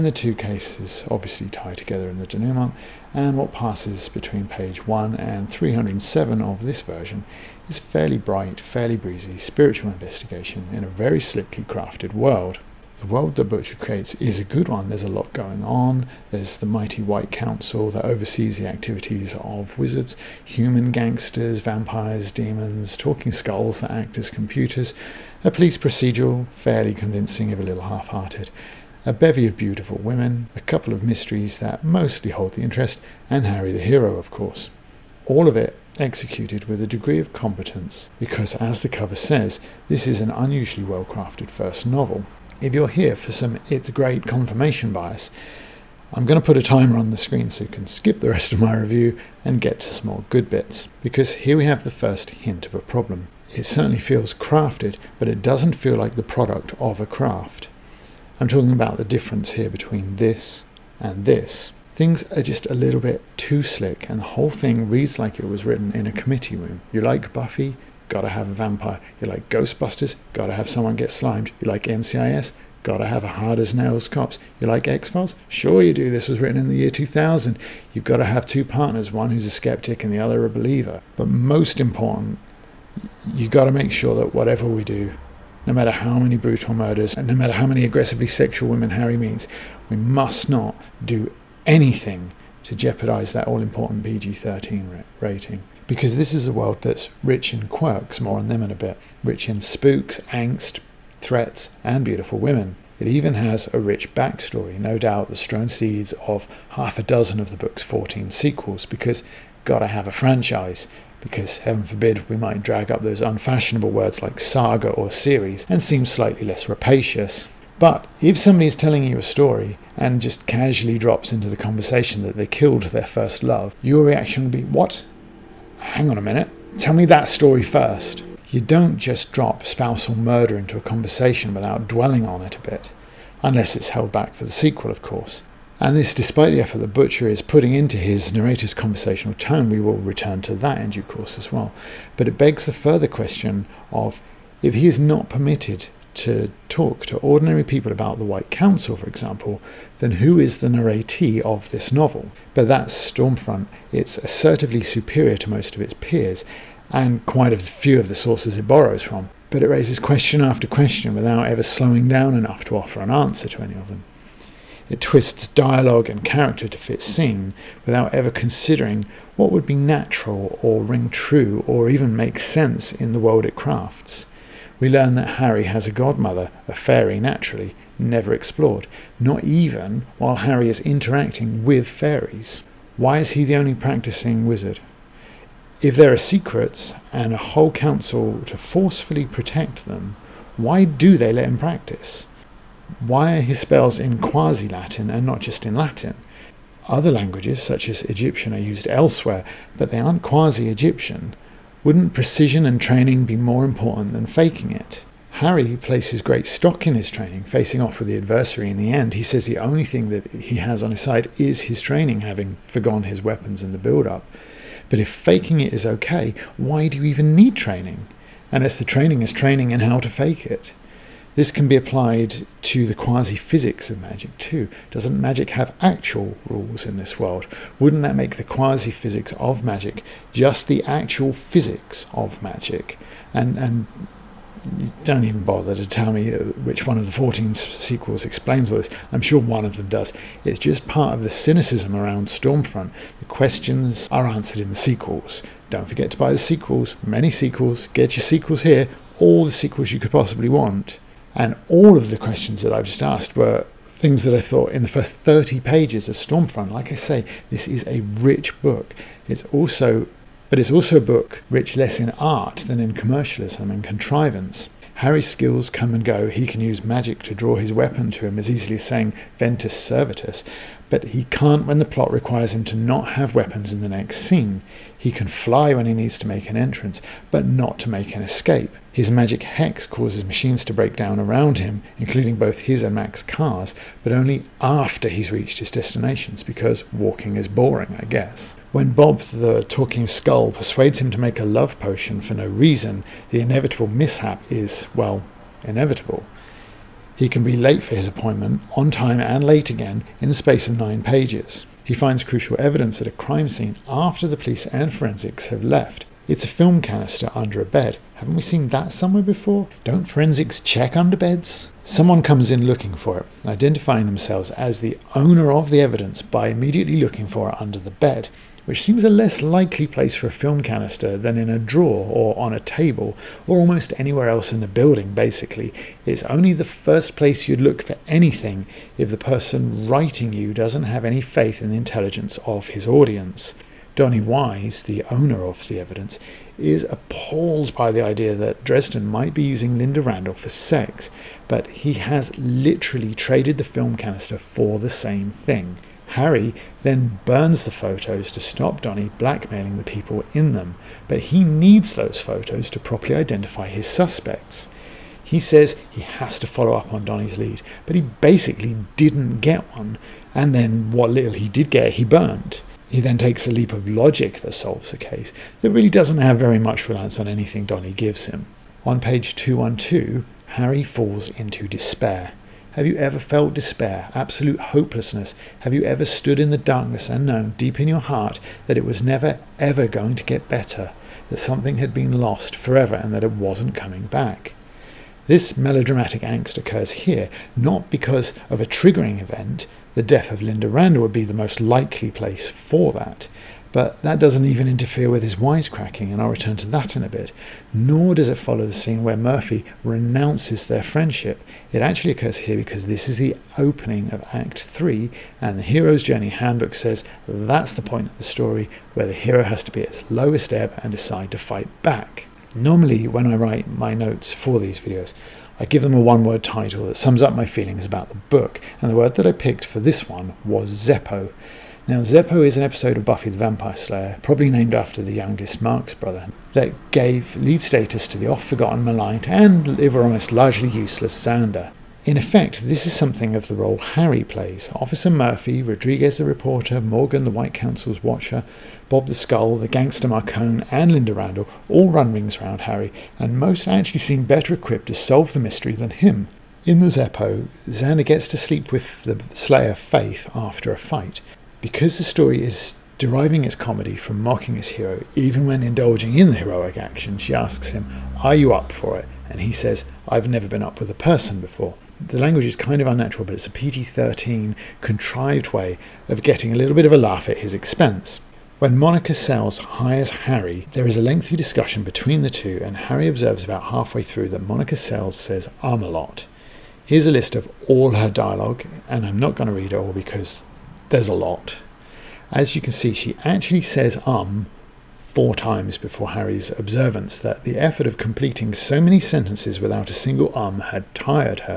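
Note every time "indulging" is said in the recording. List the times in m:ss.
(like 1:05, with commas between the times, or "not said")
7:35.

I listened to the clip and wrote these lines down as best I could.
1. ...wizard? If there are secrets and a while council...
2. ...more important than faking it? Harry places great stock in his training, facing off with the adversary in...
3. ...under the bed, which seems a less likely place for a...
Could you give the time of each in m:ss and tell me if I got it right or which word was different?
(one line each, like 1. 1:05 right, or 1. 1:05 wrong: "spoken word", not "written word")
1. 3:04 wrong: "whole", not "while"
2. 3:23 right
3. 5:17 right.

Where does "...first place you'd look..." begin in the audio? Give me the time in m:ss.
5:26.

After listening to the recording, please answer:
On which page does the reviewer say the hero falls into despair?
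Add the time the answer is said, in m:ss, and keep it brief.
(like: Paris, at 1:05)
212, at 6:09.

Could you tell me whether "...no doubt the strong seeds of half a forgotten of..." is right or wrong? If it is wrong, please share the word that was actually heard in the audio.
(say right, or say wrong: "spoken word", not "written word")
wrong: "dozen", not "forgotten".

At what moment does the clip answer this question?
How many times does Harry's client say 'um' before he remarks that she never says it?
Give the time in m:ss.
8:04.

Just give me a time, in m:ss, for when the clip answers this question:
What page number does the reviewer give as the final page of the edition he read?
0:05.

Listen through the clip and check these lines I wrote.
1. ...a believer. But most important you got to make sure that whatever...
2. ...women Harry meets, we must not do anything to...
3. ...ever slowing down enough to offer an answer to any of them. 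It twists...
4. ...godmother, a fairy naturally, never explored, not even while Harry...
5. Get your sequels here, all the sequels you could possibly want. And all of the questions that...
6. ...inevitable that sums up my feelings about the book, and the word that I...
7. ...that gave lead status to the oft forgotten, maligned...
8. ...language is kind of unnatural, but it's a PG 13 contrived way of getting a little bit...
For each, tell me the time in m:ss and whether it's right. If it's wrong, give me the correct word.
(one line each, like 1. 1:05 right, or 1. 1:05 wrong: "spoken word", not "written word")
1. 1:20 right
2. 1:28 right
3. 2:41 right
4. 2:55 right
5. 4:07 right
6. 6:56 wrong: "title", not "inevitable"
7. 7:06 right
8. 7:42 right.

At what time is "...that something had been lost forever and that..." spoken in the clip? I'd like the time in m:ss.
6:21.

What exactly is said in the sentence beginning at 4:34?
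He can fly when he needs to make an entrance, but not to make an escape.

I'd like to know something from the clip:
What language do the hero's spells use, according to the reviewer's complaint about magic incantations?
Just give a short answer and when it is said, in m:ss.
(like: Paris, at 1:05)
Quasi Latin, at 3:14.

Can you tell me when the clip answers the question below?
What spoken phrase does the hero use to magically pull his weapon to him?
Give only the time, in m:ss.
4:29.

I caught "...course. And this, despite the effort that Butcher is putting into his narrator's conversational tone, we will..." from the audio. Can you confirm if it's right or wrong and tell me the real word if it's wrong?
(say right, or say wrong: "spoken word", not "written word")
right.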